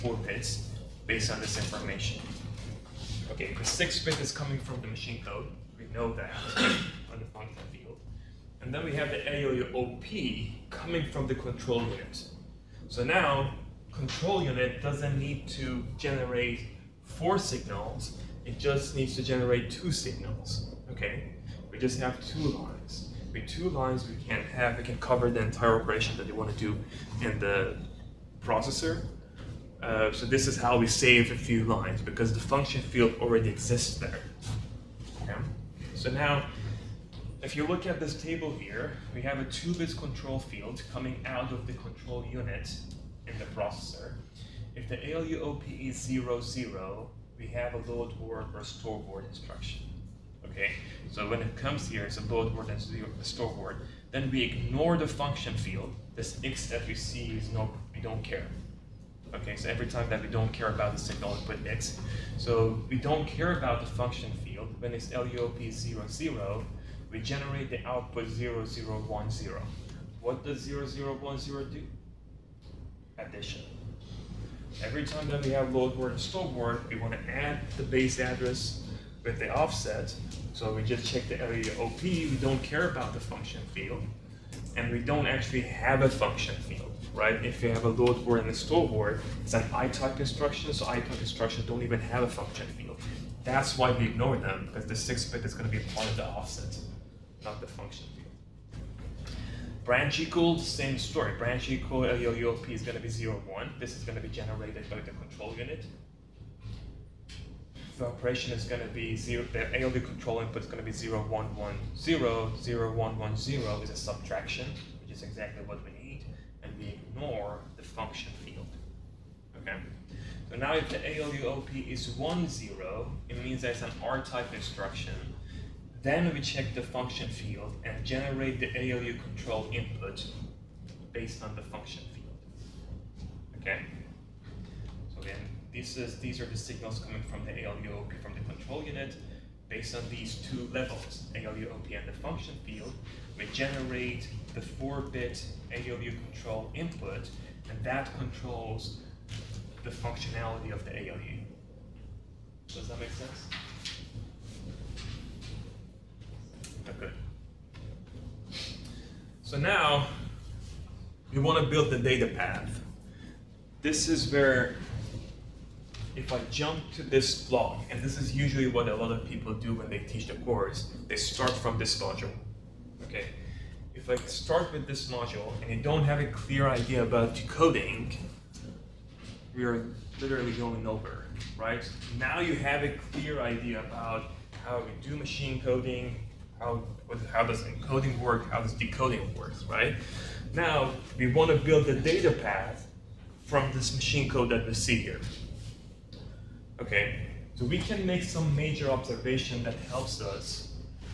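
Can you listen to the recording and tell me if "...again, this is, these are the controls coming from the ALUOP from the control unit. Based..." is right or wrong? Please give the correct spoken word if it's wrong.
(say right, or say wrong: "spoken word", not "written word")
wrong: "signals", not "controls".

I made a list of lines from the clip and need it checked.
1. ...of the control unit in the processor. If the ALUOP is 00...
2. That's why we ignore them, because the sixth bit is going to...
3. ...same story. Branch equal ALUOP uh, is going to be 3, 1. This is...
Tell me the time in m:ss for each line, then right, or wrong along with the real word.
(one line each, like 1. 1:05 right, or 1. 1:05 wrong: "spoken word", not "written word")
1. 0:41 right
2. 1:33 right
3. 1:40 wrong: "0", not "3".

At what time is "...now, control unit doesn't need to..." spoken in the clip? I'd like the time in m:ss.
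0:13.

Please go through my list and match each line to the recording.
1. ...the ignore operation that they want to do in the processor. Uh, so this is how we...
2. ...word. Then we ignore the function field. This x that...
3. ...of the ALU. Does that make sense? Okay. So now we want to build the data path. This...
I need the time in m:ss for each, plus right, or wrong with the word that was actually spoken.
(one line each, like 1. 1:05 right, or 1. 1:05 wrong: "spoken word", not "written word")
1. 0:25 wrong: "entire", not "ignore"
2. 0:53 right
3. 2:30 right.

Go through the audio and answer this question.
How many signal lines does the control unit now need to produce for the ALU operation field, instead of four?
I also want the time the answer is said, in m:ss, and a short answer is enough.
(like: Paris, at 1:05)
2, at 0:19.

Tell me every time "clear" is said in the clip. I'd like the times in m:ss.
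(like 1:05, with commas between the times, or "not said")
2:56, 3:03.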